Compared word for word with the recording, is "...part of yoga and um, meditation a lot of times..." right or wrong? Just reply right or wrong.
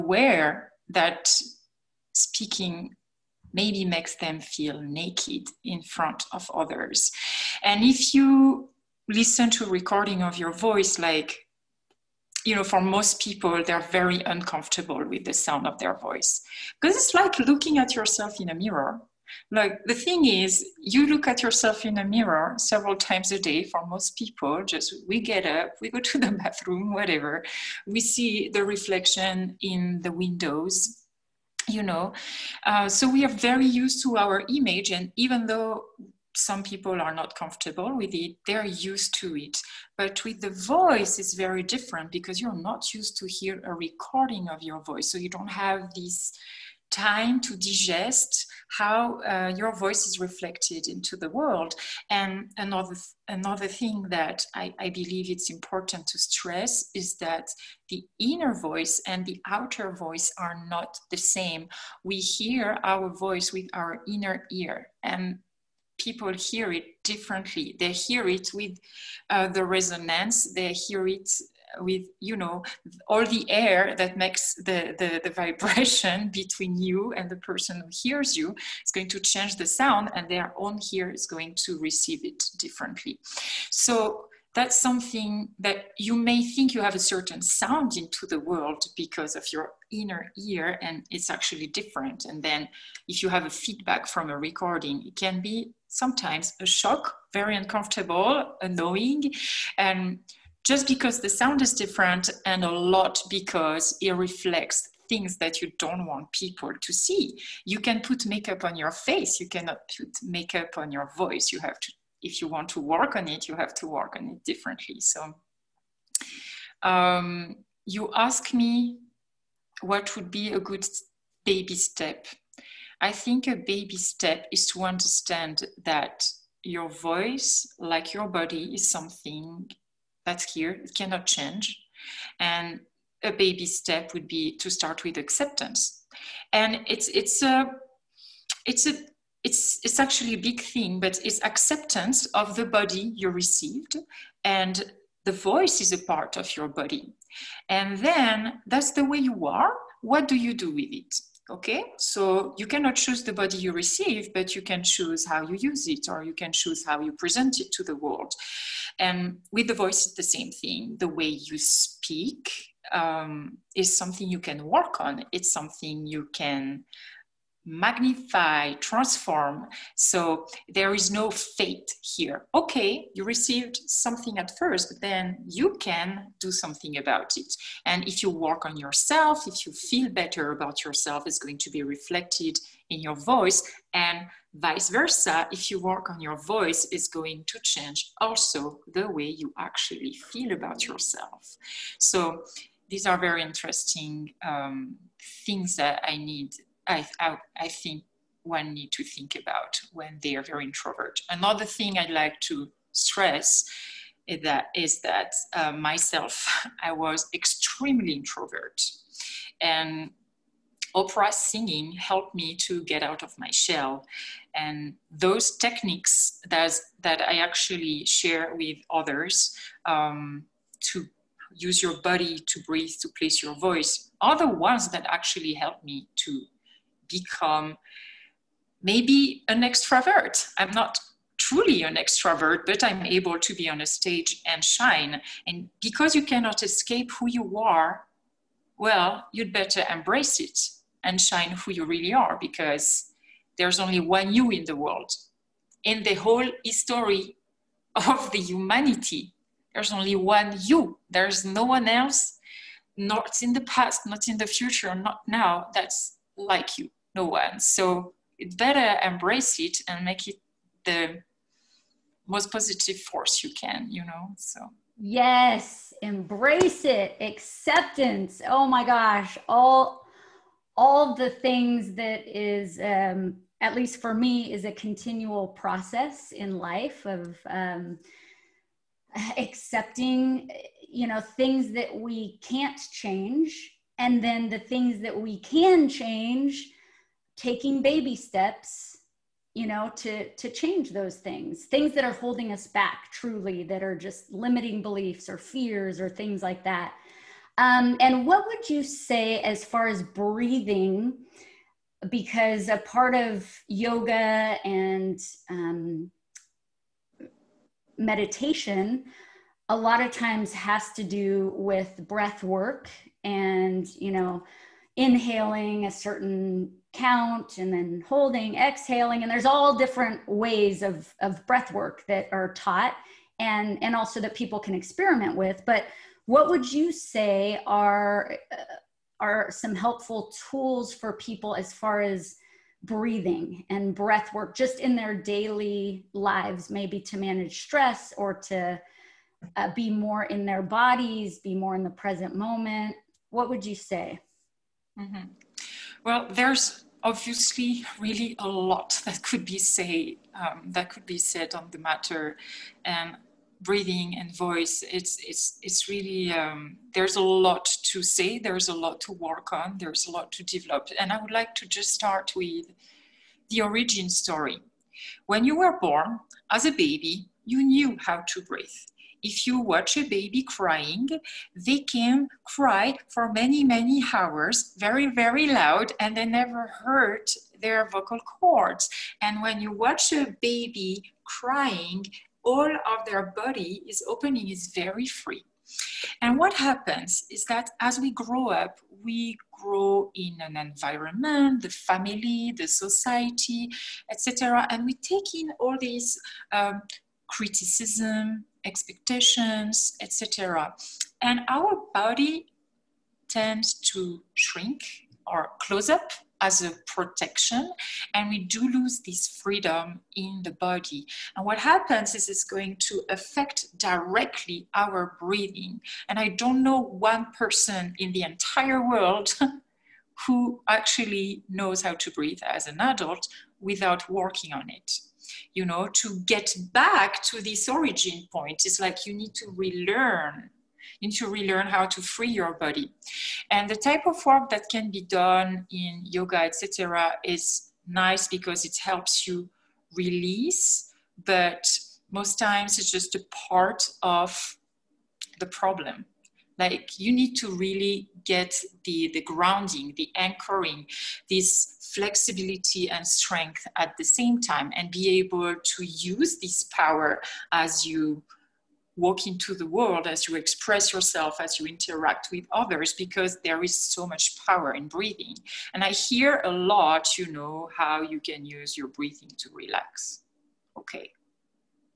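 right.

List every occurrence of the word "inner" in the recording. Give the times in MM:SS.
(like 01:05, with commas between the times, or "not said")
00:58, 01:04, 01:29.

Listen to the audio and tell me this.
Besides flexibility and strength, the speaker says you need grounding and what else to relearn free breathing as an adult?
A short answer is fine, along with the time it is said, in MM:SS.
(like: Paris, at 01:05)
anchoring, at 07:30.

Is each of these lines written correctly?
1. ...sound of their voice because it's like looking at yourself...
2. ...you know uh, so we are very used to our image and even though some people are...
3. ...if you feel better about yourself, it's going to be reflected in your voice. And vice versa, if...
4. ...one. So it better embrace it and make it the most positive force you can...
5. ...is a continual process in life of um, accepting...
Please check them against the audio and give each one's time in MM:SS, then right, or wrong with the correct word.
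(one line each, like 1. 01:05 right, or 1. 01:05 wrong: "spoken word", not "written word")
1. 00:15 right
2. 00:31 right
3. 02:59 right
4. 04:17 right
5. 04:34 right.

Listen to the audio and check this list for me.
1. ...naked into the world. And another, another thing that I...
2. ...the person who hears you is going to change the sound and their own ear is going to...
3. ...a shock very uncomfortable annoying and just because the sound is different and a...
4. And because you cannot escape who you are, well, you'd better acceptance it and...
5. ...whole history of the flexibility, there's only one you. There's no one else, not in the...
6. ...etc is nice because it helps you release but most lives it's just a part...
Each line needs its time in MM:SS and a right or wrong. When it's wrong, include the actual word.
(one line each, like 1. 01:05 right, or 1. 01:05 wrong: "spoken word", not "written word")
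1. 00:50 wrong: "reflected", not "naked"
2. 01:17 right
3. 01:36 right
4. 03:55 wrong: "embrace", not "acceptance"
5. 04:06 wrong: "humanity", not "flexibility"
6. 07:16 wrong: "times", not "lives".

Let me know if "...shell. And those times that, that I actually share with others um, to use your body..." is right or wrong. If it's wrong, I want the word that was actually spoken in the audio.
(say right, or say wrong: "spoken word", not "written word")
wrong: "techniques", not "times".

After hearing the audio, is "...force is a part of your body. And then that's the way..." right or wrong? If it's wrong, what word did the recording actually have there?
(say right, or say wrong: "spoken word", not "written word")
wrong: "voice", not "force".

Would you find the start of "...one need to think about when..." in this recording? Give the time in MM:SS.
03:18.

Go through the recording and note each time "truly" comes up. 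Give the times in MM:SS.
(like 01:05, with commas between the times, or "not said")
03:51, 04:53.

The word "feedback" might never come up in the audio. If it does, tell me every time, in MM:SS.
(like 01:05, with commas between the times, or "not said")
01:33.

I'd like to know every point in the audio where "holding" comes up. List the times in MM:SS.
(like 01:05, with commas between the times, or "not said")
04:52, 05:18.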